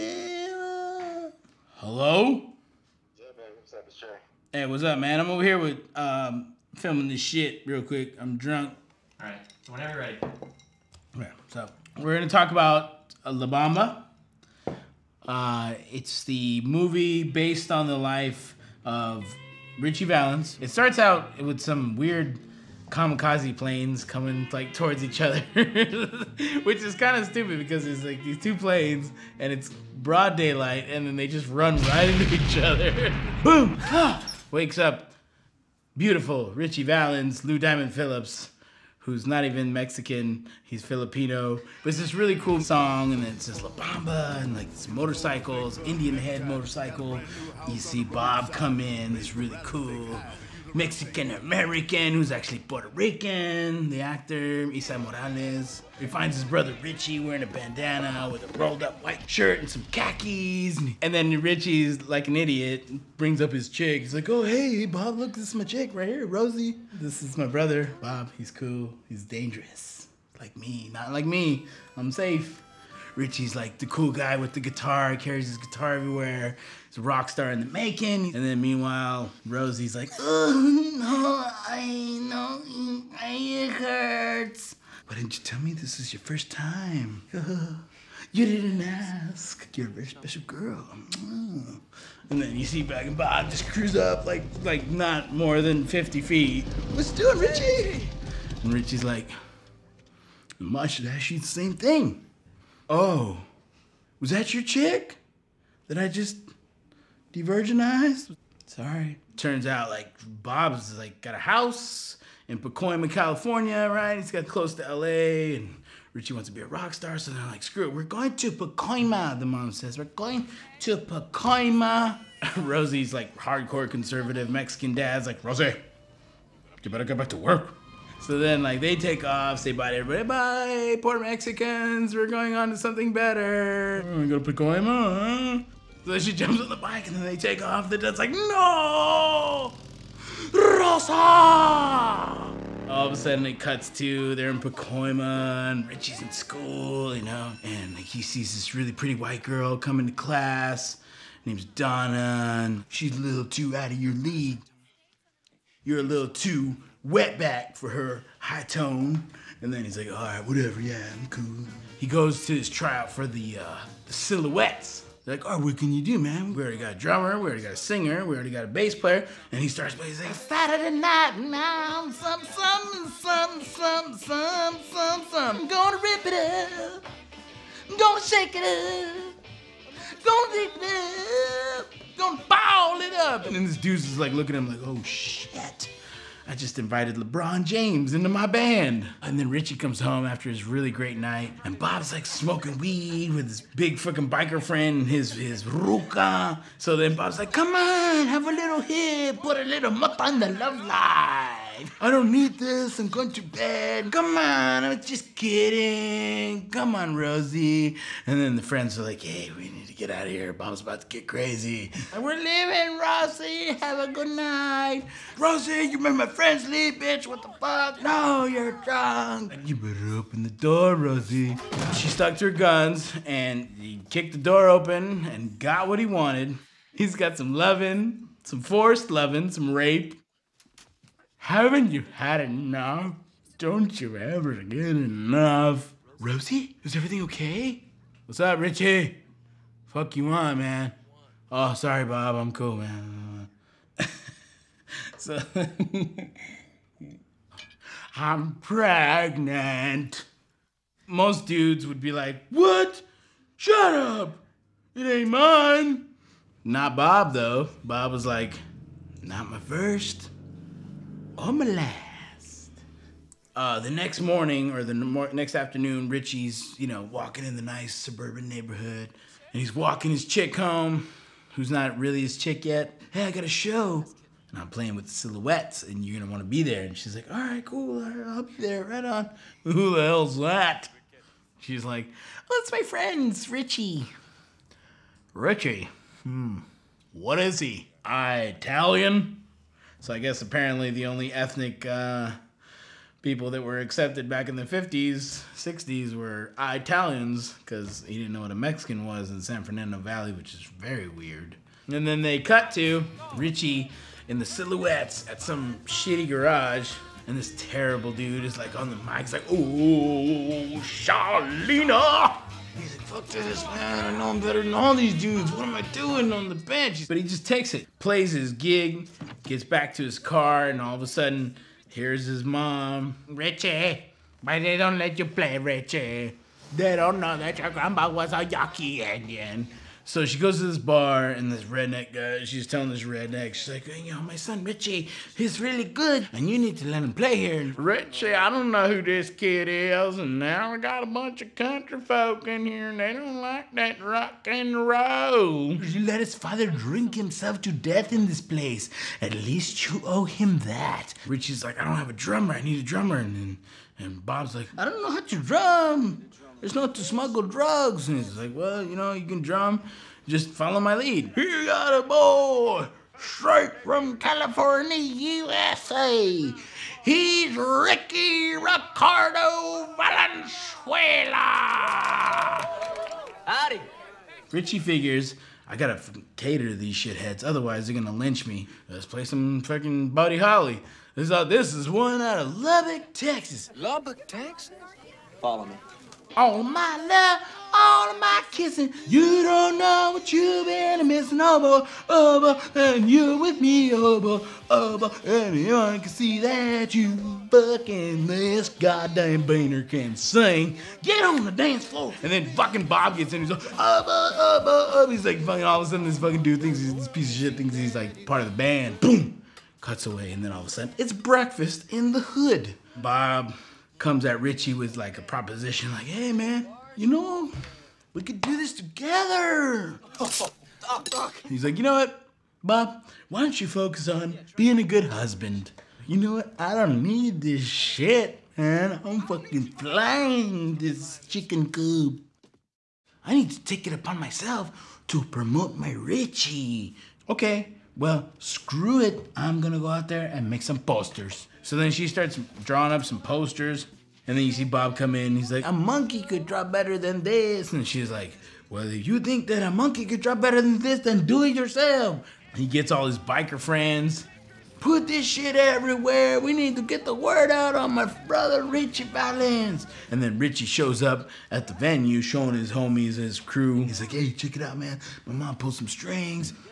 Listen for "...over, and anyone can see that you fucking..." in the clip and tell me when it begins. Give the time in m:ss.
6:34.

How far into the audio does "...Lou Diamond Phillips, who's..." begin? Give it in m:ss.
0:37.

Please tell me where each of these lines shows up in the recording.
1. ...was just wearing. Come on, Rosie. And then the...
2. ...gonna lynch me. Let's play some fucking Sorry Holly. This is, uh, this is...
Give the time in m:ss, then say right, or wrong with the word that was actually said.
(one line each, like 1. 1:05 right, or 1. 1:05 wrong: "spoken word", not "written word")
1. 3:24 wrong: "kidding", not "wearing"
2. 6:17 wrong: "Buddy", not "Sorry".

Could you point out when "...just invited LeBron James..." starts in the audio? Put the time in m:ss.
3:06.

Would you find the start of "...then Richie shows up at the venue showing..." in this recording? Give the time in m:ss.
7:40.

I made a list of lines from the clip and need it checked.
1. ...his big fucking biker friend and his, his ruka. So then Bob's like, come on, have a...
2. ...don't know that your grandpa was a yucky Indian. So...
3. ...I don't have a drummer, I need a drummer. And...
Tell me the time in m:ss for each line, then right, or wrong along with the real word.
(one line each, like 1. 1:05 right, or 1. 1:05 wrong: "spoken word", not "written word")
1. 3:13 right
2. 5:26 right
3. 5:51 right.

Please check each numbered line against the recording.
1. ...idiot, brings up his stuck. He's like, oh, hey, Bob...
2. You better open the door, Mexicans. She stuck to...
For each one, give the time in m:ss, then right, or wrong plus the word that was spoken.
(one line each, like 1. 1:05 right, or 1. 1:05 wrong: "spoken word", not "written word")
1. 1:02 wrong: "chick", not "stuck"
2. 3:39 wrong: "Rosie", not "Mexicans".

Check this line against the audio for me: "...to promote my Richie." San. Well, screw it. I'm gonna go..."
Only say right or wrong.
wrong.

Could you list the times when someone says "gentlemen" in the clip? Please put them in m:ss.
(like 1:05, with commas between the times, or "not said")
not said.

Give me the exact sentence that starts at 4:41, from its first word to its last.
She's like, "Oh, it's my friends, Richie." Richie.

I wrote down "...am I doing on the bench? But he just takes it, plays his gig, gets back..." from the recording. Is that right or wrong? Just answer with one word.
right.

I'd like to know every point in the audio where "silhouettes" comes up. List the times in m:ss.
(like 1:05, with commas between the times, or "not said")
2:44, 4:35, 5:04.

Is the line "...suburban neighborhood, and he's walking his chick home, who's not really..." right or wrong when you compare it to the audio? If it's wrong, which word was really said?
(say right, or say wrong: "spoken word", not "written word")
right.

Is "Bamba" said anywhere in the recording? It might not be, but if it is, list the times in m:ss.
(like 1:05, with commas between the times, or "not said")
0:13, 0:43.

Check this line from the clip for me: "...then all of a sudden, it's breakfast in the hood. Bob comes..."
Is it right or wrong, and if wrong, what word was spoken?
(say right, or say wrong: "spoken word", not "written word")
right.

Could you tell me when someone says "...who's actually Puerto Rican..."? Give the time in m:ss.
0:52.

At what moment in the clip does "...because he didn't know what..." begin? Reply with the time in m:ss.
4:57.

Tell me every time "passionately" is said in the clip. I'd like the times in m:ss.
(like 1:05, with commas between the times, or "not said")
not said.